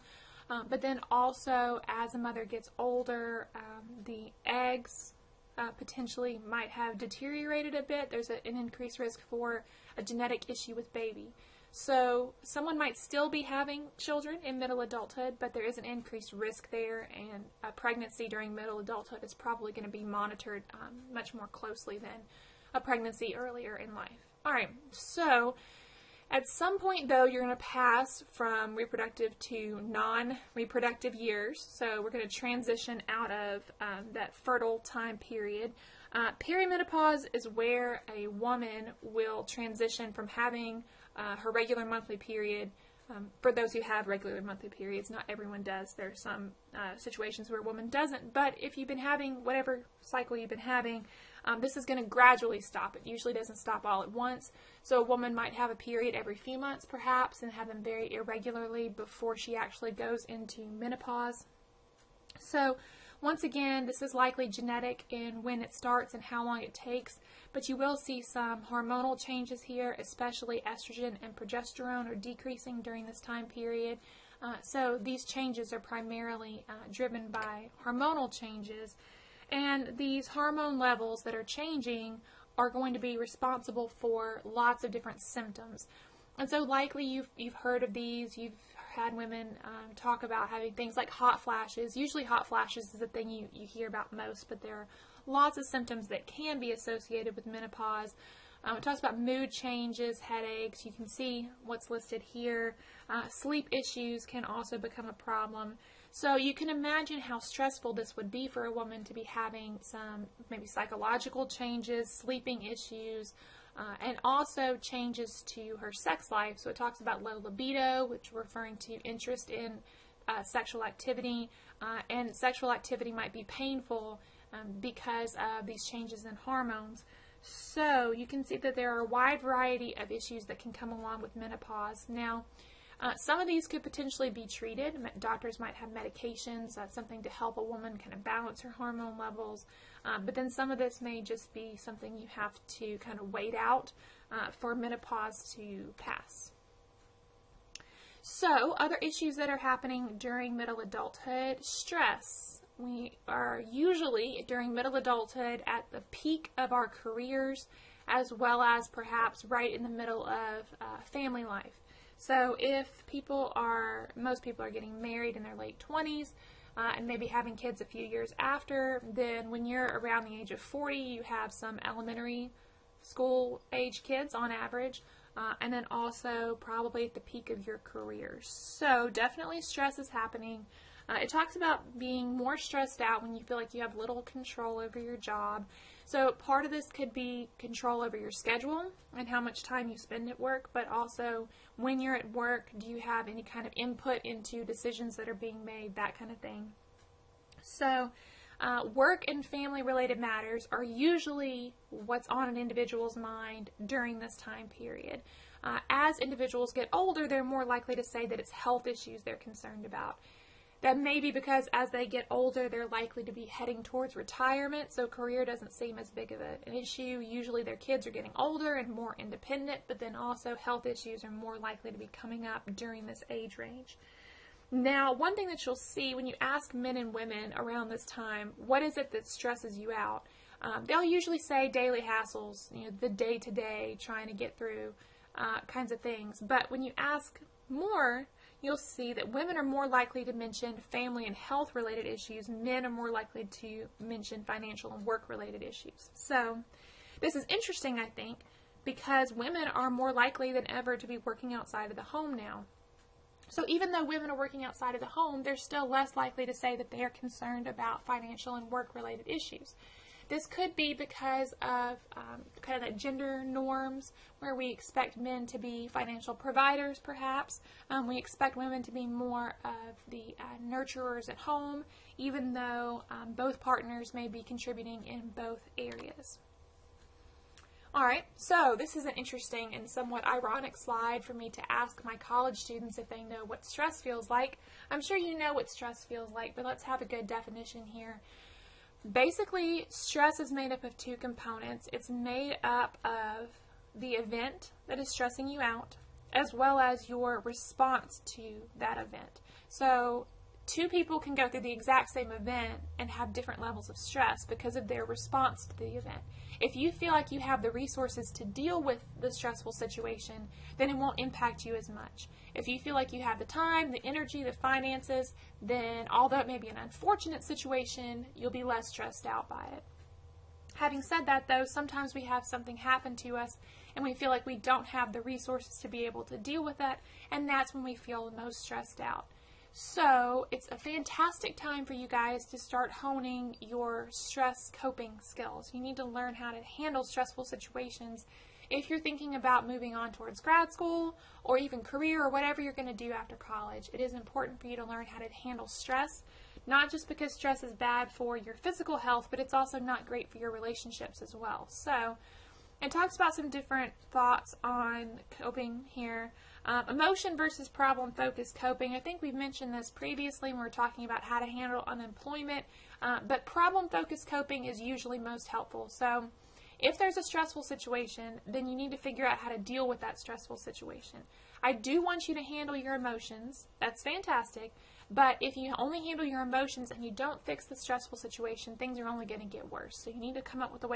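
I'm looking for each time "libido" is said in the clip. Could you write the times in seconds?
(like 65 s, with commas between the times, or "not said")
117 s.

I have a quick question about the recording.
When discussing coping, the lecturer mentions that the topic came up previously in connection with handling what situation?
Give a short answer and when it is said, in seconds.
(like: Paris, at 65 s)
Unemployment, at 361 s.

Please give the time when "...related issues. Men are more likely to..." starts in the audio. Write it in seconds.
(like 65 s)
241 s.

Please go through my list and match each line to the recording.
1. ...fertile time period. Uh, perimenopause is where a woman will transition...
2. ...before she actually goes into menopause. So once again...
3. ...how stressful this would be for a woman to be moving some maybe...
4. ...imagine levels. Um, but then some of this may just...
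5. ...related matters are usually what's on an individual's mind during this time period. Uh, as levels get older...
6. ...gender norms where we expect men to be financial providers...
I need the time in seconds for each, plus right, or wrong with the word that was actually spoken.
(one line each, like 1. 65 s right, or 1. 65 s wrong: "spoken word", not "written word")
1. 34 s right
2. 58 s right
3. 107 s wrong: "having", not "moving"
4. 138 s wrong: "hormone", not "imagine"
5. 199 s wrong: "individuals", not "levels"
6. 262 s right.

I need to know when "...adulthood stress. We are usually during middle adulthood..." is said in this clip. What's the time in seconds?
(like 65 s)
150 s.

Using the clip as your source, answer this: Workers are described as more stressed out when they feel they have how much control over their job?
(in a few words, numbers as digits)
Little control.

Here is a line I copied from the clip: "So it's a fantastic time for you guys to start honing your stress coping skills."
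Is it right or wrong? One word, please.
right.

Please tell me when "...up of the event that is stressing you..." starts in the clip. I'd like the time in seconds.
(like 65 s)
292 s.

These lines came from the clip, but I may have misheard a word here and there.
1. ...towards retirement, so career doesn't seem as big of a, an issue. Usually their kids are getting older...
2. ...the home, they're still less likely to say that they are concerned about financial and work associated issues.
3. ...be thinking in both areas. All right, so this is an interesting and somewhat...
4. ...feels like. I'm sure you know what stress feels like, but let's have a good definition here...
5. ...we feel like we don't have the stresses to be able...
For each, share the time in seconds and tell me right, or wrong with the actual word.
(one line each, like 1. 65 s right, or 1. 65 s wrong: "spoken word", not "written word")
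1. 213 s right
2. 255 s wrong: "related", not "associated"
3. 274 s wrong: "contributing", not "thinking"
4. 284 s right
5. 324 s wrong: "resources", not "stresses".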